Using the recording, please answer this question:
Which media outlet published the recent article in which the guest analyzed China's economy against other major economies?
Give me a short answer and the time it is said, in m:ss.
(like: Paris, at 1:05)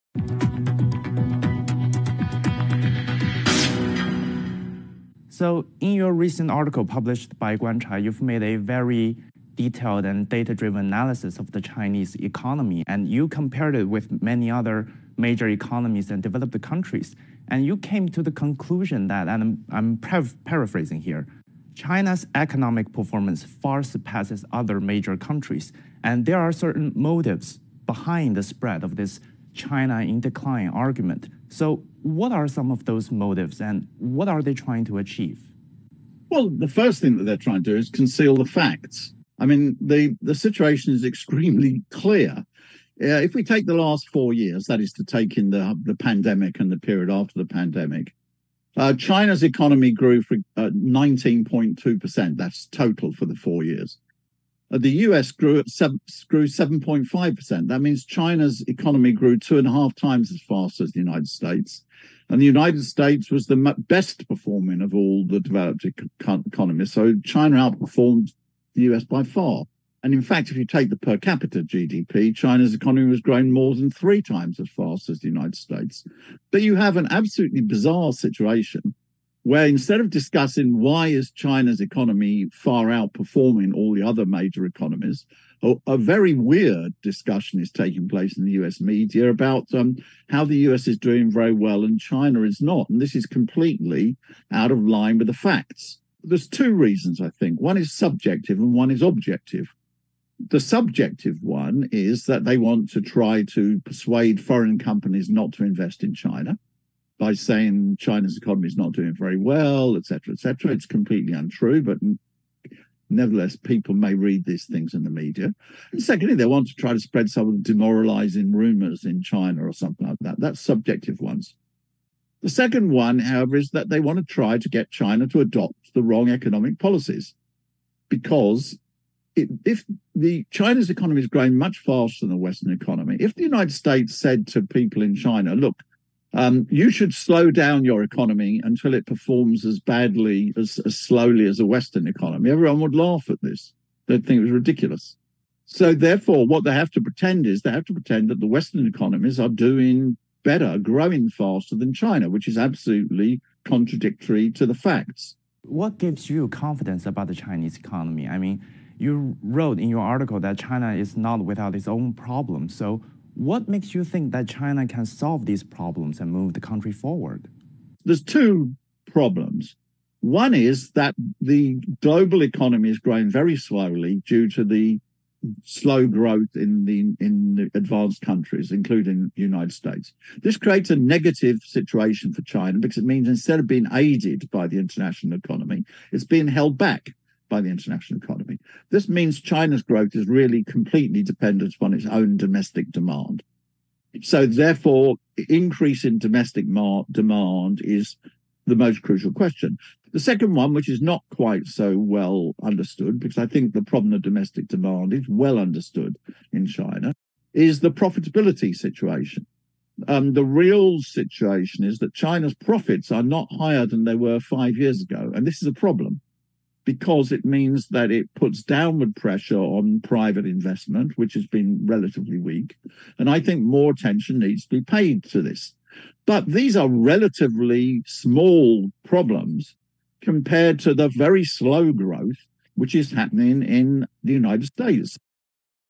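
Guancha, at 0:07.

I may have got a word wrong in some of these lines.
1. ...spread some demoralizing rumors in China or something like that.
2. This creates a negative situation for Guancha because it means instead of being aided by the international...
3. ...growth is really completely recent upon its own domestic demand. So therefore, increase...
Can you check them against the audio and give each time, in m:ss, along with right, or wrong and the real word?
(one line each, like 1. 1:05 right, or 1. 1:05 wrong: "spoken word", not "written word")
1. 1:56 right
2. 3:00 wrong: "China", not "Guancha"
3. 3:09 wrong: "dependent", not "recent".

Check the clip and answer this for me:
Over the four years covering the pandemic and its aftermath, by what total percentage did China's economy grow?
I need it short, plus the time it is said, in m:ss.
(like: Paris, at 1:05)
19.2%, at 0:50.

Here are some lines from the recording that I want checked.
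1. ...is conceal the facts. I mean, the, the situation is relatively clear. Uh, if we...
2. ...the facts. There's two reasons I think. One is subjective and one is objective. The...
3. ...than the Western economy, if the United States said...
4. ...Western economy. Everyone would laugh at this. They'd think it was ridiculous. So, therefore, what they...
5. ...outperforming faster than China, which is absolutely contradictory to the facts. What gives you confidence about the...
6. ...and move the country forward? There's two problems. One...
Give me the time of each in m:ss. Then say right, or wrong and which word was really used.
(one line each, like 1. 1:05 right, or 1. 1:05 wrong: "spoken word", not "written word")
1. 0:37 wrong: "extremely", not "relatively"
2. 1:35 right
3. 2:12 right
4. 2:21 right
5. 2:30 wrong: "growing", not "outperforming"
6. 2:46 right.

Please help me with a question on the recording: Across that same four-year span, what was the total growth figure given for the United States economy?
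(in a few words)
7.5%.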